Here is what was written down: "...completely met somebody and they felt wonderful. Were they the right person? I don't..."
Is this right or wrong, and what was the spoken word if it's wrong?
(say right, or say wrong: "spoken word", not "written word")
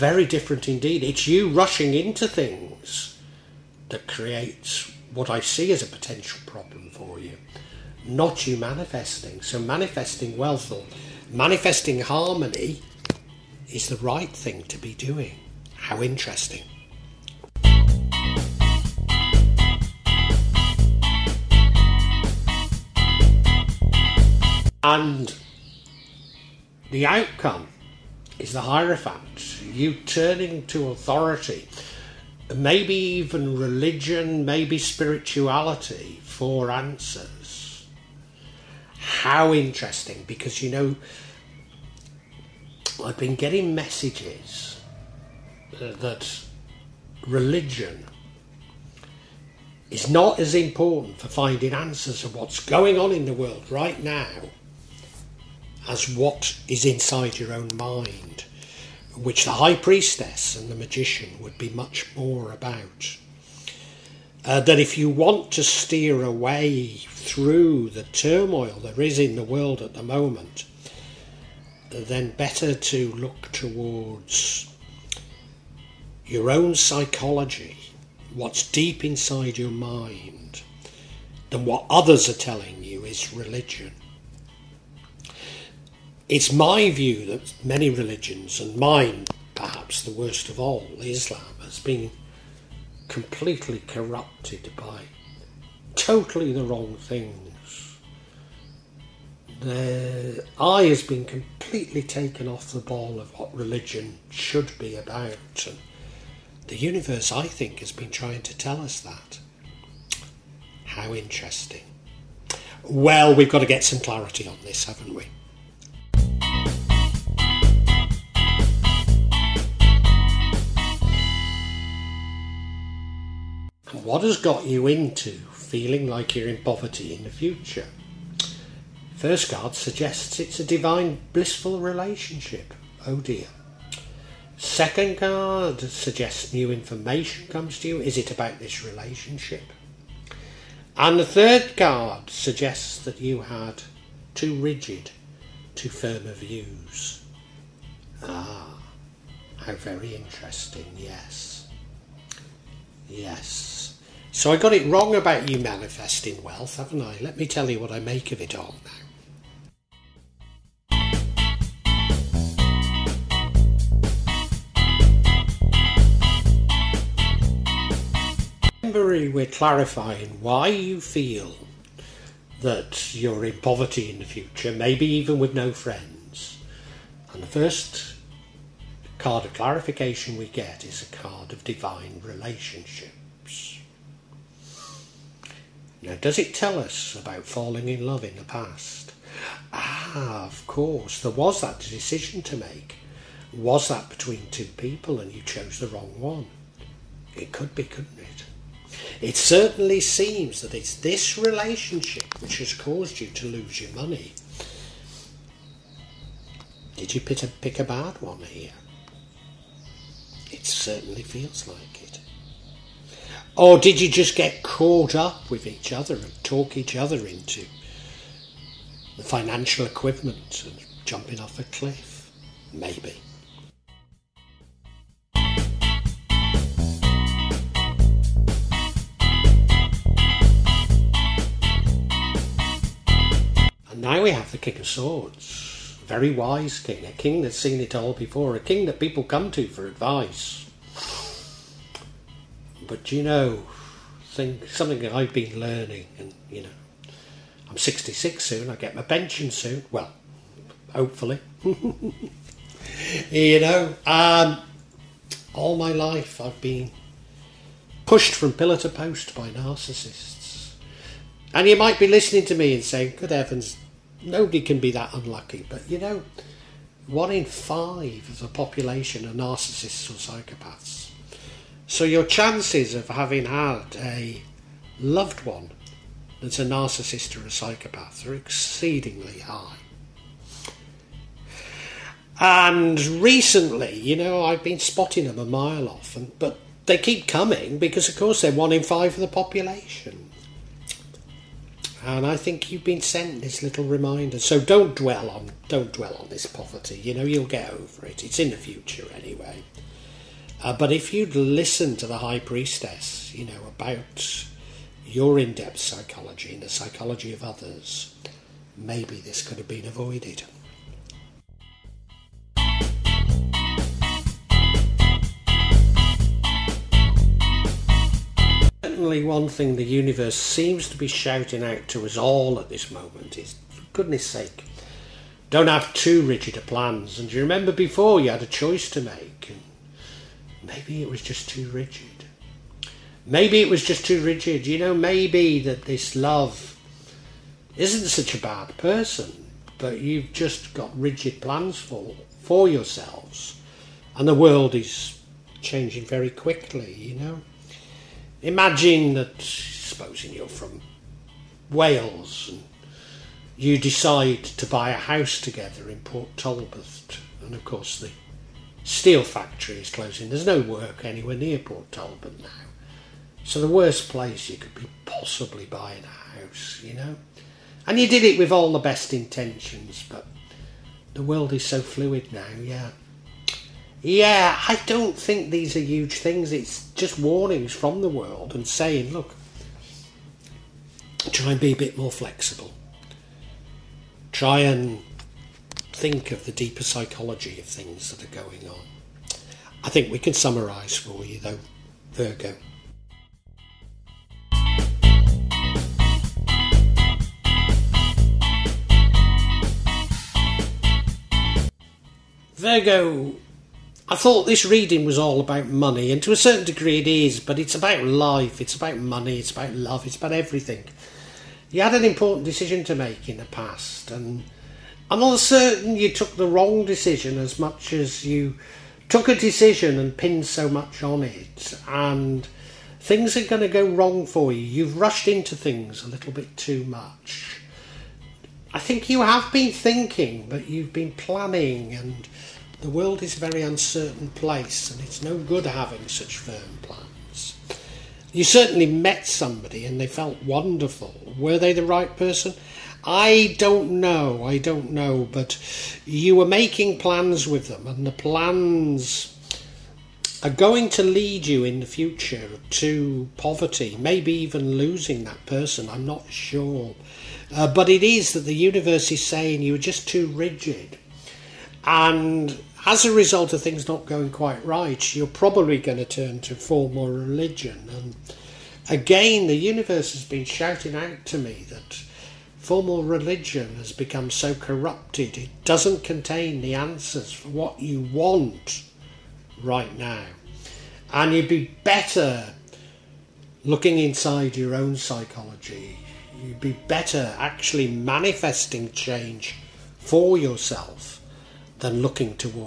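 wrong: "certainly", not "completely".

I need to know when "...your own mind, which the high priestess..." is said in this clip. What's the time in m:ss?
0:57.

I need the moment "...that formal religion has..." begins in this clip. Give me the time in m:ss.
7:51.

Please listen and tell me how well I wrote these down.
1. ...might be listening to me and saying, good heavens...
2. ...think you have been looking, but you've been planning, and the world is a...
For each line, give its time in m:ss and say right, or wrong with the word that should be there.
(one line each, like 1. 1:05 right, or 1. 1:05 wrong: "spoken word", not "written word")
1. 4:21 right
2. 7:08 wrong: "thinking", not "looking".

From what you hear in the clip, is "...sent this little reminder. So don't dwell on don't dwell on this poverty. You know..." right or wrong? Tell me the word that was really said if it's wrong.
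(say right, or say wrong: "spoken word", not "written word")
right.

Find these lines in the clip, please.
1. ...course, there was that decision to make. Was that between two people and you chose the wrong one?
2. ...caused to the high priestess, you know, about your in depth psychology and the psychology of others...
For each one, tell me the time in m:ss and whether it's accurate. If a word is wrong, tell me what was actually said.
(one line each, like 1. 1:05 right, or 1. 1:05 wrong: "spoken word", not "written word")
1. 3:10 right
2. 5:01 wrong: "listened", not "caused".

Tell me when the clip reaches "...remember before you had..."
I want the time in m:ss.
5:27.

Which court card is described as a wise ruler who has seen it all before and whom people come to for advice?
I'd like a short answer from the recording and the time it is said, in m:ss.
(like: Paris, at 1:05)
King of Swords, at 3:54.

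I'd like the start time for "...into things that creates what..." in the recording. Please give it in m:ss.
0:01.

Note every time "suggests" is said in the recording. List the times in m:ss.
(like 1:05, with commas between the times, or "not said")
2:09, 2:15, 2:22.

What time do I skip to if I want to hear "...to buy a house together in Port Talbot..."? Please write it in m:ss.
5:54.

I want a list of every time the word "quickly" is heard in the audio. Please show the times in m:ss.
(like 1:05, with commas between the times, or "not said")
5:46.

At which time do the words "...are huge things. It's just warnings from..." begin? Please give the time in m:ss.
6:15.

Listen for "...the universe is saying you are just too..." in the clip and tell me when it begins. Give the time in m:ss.
7:38.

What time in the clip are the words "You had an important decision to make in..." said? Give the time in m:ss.
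6:51.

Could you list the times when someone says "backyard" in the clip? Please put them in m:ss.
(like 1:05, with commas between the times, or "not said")
not said.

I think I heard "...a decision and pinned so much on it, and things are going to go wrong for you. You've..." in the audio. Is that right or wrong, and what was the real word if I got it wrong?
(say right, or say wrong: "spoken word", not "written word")
right.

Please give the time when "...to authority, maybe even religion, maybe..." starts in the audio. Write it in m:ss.
0:30.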